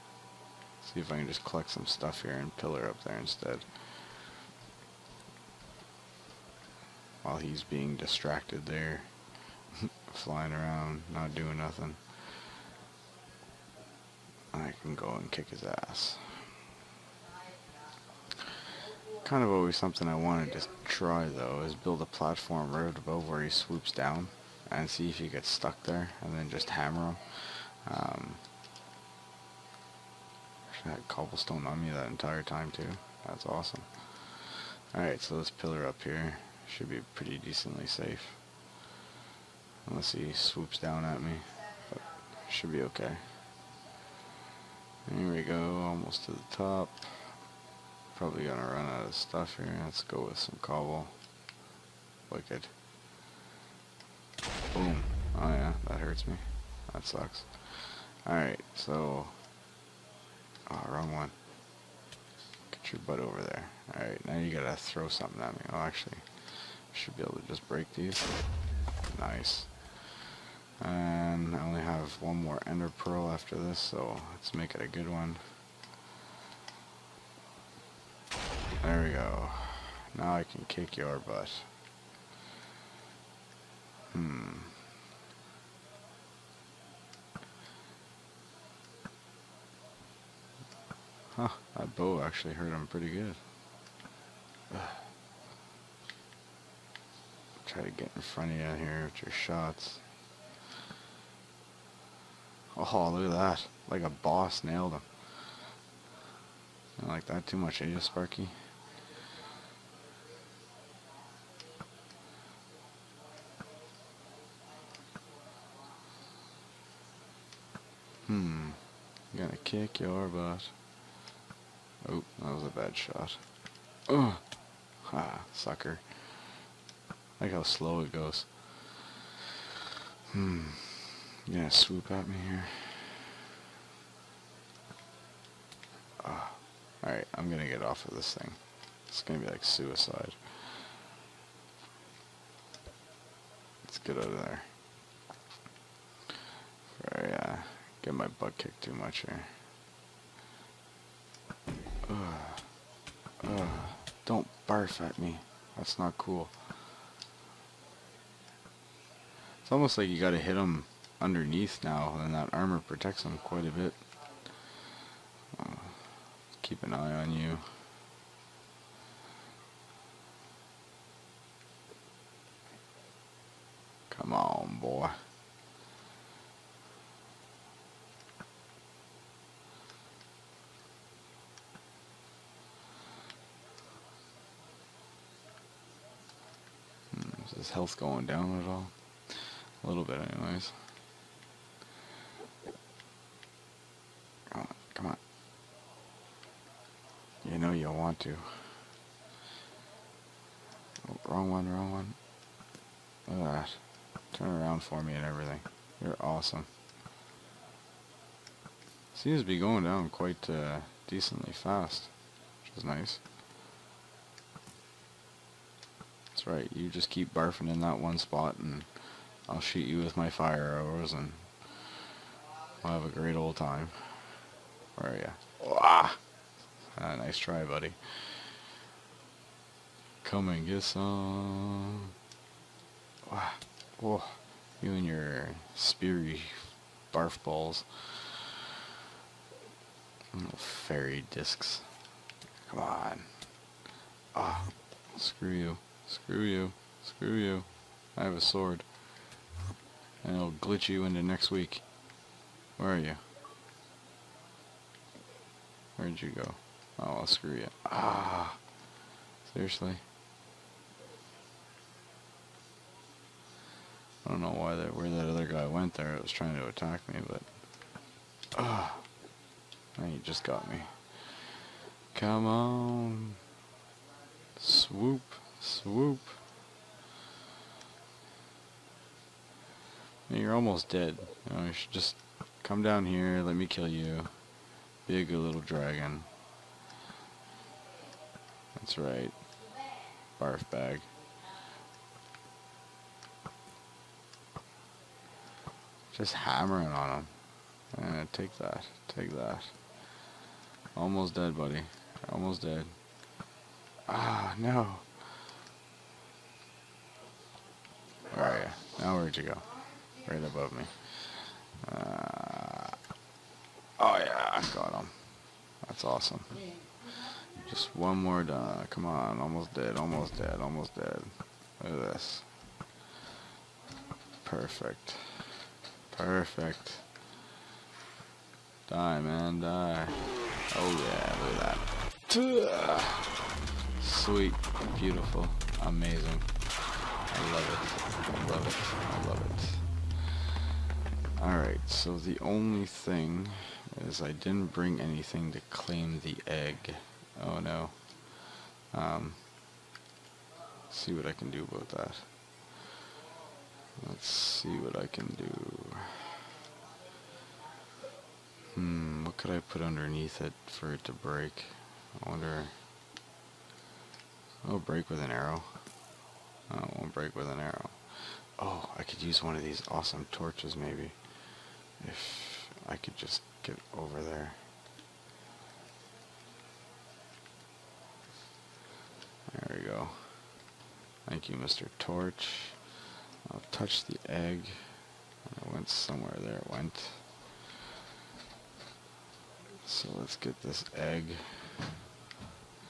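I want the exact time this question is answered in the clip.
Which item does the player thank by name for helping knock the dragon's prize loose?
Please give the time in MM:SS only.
06:21.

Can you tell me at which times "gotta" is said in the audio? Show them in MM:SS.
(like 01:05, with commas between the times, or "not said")
01:04, 02:40.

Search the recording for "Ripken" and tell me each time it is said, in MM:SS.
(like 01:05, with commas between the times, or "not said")
not said.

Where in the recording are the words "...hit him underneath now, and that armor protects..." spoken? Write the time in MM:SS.
02:40.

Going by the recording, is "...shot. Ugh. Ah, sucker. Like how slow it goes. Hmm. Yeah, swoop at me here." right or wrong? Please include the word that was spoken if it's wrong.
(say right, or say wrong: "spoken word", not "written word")
right.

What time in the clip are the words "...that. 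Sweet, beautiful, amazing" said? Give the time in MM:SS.
05:32.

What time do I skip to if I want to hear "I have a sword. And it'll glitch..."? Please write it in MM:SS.
04:08.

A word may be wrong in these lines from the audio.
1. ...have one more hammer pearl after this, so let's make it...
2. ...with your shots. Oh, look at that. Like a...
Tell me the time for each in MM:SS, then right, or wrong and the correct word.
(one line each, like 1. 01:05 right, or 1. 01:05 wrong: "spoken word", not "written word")
1. 01:11 wrong: "ender", not "hammer"
2. 01:39 right.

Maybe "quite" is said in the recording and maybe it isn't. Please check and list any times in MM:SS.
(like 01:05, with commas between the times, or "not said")
02:43, 03:30.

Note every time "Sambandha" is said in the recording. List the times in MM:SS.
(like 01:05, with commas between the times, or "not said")
not said.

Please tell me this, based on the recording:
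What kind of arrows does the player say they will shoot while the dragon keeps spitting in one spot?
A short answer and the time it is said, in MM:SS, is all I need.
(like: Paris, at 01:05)
Fire arrows, at 03:40.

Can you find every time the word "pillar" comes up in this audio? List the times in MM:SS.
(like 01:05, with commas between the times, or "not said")
00:02, 00:35.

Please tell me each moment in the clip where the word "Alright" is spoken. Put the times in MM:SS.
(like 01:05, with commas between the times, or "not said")
00:34, 00:58, 01:03, 02:17, 05:41.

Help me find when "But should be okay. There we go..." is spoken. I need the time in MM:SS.
00:41.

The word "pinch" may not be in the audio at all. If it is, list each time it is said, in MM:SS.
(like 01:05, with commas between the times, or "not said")
not said.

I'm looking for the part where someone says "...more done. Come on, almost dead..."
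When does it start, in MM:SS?
05:18.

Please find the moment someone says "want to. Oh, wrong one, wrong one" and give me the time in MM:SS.
03:18.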